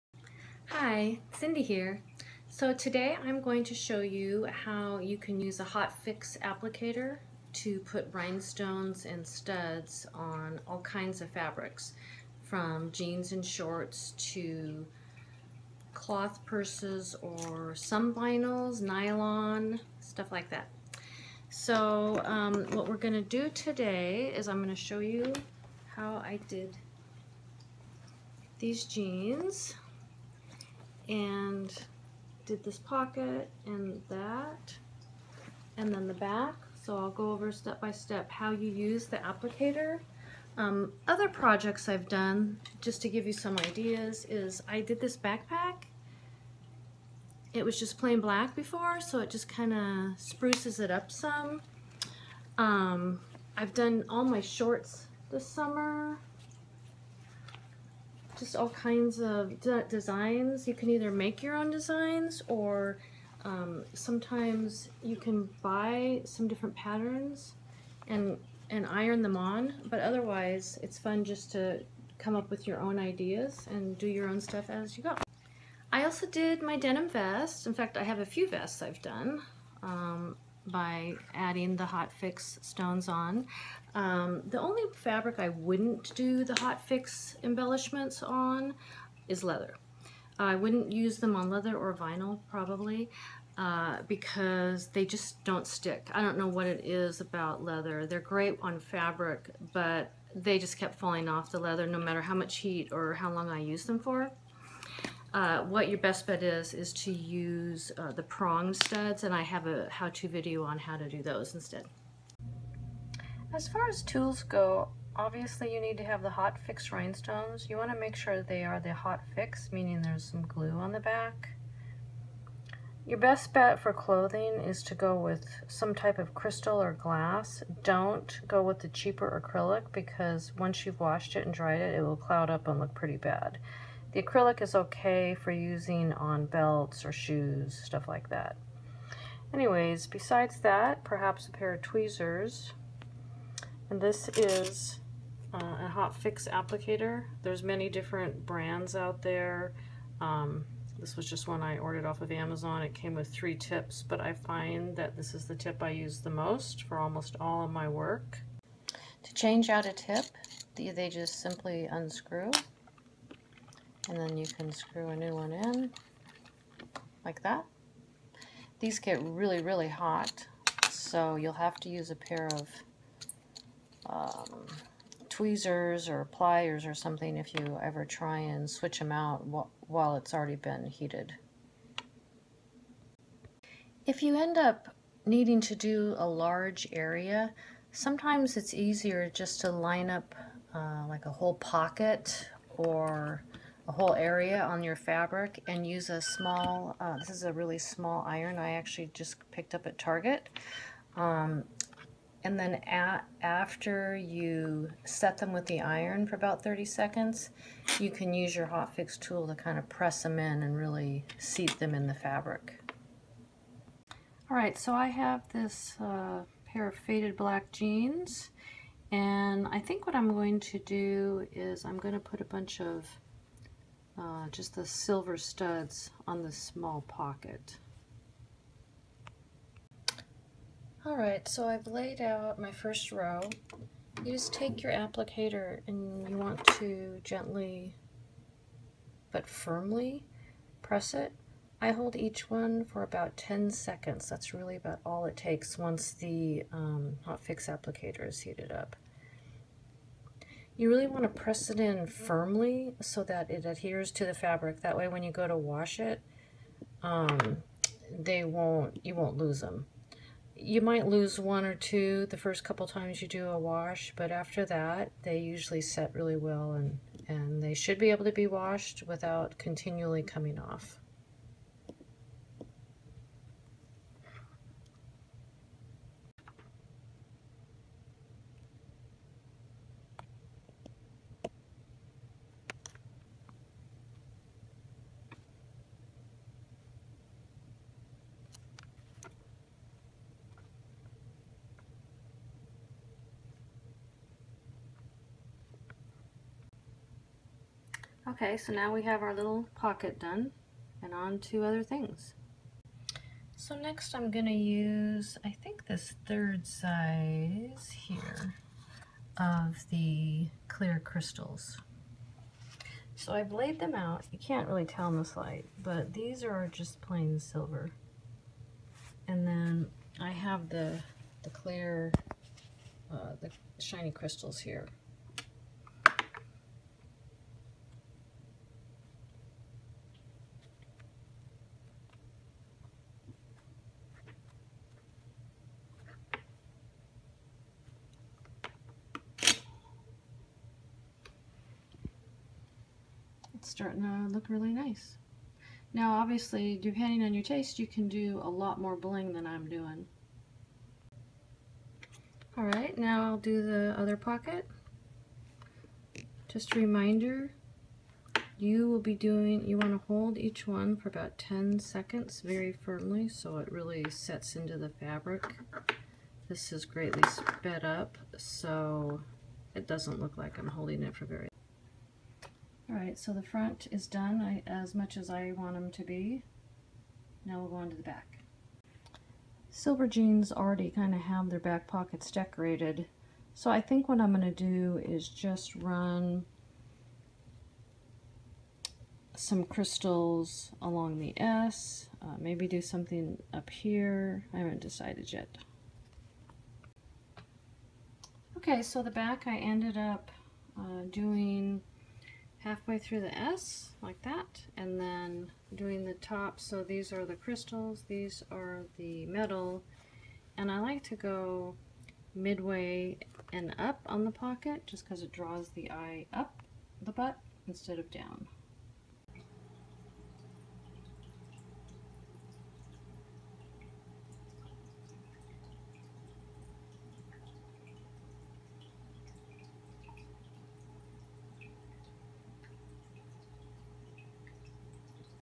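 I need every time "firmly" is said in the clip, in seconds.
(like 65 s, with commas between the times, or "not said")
239 s, 252 s, 362 s.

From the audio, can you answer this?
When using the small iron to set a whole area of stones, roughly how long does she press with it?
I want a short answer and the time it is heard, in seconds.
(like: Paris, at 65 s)
30 seconds, at 206 s.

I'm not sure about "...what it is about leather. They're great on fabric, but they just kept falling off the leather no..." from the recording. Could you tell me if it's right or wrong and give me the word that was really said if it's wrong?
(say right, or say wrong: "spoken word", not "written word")
right.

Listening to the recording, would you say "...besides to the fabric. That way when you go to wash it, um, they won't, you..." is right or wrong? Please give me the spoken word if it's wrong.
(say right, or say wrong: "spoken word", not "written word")
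wrong: "adheres", not "besides".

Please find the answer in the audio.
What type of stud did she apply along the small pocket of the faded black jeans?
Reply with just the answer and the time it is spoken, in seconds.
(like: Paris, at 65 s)
Silver studs, at 224 s.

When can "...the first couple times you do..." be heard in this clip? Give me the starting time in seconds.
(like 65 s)
262 s.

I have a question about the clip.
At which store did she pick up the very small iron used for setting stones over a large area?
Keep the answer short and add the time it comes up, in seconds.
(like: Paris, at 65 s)
Target, at 199 s.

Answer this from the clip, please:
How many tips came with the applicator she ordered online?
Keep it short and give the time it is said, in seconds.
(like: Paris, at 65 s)
3, at 153 s.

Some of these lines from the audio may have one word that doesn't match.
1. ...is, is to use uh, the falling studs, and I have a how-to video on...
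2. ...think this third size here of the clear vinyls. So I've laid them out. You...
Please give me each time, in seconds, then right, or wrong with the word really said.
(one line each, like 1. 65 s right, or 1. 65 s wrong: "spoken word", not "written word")
1. 106 s wrong: "prong", not "falling"
2. 305 s wrong: "crystals", not "vinyls".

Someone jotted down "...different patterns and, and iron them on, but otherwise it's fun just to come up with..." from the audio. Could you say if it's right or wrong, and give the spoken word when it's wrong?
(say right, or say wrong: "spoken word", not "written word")
right.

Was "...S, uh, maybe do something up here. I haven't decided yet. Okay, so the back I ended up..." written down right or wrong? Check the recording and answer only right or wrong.
right.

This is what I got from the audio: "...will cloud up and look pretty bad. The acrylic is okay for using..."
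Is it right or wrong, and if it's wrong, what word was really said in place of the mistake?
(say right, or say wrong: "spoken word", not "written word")
right.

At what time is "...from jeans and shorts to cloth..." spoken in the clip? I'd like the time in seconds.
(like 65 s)
12 s.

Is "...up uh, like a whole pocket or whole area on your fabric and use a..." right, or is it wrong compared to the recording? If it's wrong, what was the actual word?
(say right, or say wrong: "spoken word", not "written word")
right.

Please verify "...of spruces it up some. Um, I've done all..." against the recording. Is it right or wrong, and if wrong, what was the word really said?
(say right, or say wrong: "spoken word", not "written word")
right.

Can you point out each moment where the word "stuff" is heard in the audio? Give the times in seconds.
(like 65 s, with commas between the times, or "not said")
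19 s, 74 s, 137 s.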